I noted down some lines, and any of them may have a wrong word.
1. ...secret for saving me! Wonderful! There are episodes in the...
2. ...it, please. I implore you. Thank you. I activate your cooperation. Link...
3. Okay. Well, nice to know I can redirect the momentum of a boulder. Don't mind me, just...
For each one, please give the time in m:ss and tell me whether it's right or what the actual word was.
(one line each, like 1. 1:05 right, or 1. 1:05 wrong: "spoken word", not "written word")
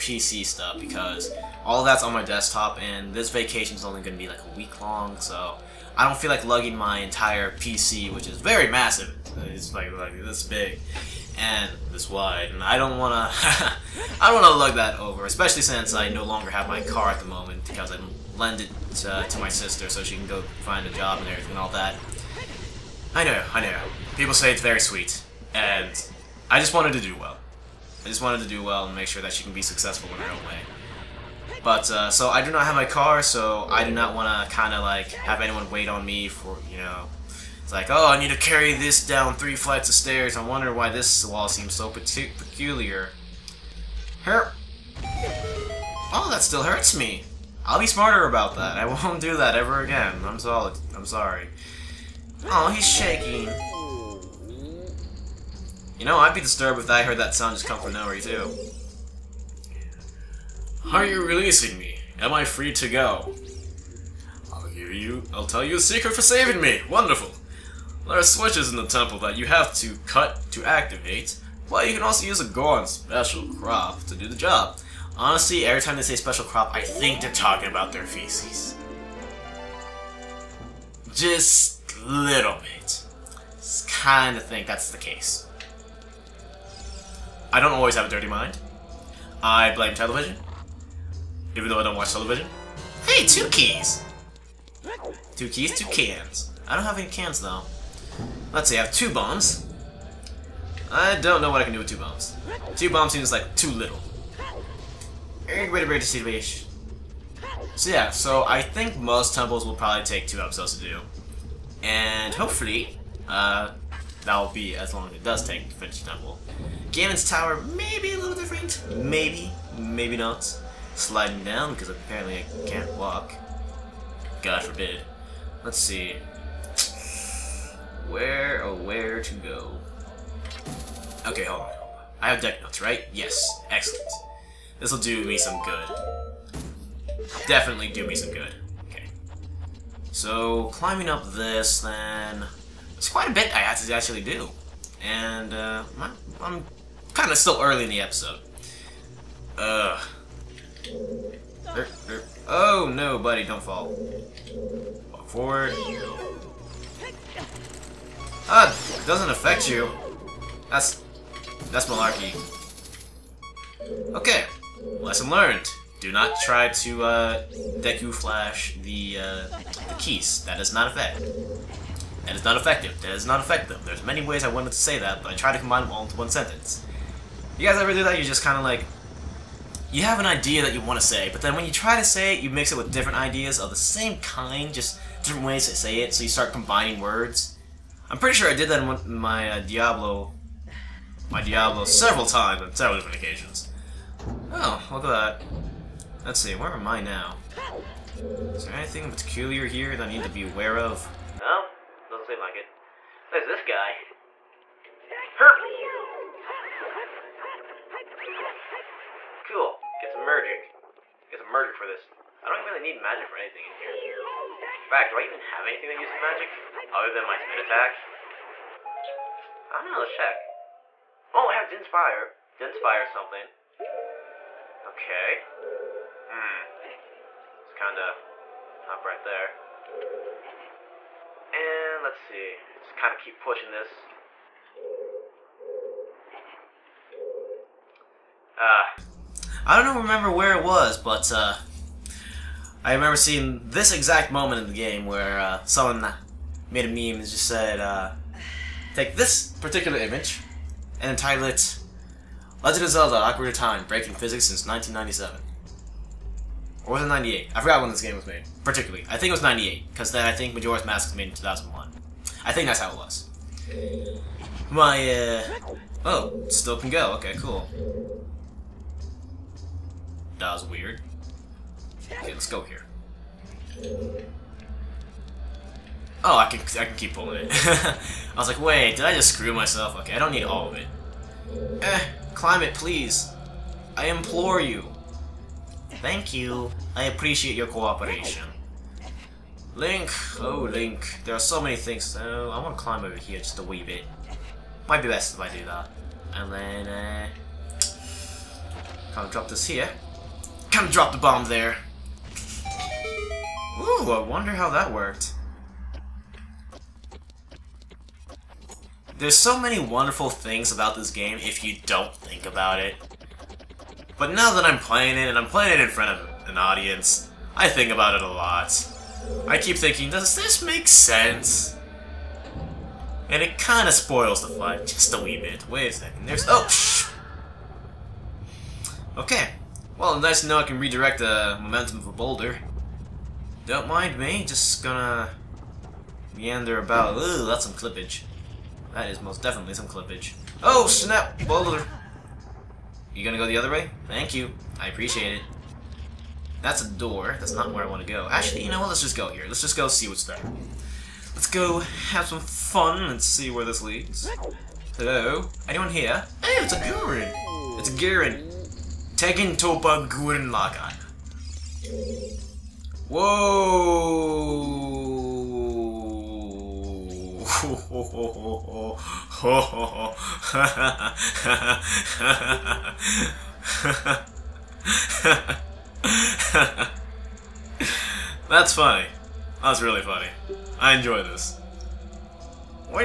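1. 1:05 wrong: "switches", not "episodes"
2. 4:42 wrong: "appreciate", not "activate"
3. 5:29 right.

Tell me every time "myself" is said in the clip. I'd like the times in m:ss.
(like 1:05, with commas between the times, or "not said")
4:39.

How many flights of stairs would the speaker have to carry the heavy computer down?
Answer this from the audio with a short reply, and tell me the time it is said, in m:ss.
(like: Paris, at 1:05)
3, at 0:39.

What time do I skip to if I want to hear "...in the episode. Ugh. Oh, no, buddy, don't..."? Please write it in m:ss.
2:27.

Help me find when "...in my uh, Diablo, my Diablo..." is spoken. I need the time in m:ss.
3:09.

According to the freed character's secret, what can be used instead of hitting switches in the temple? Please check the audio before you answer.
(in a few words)
Goron special crop.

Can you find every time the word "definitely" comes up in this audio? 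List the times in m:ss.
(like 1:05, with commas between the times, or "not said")
2:17, 5:39.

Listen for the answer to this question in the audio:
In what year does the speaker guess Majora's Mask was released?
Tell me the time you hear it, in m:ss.
4:21.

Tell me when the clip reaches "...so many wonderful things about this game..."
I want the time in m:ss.
5:09.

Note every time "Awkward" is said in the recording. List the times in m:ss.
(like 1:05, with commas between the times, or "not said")
4:13.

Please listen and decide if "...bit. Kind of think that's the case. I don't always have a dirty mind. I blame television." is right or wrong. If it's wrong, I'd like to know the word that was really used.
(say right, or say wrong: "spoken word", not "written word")
right.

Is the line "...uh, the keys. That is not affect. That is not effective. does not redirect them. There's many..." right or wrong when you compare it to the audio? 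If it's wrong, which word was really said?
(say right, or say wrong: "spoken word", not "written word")
wrong: "affect", not "redirect".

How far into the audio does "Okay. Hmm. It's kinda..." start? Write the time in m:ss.
3:44.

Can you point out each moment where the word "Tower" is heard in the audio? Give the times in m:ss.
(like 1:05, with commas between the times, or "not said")
1:57.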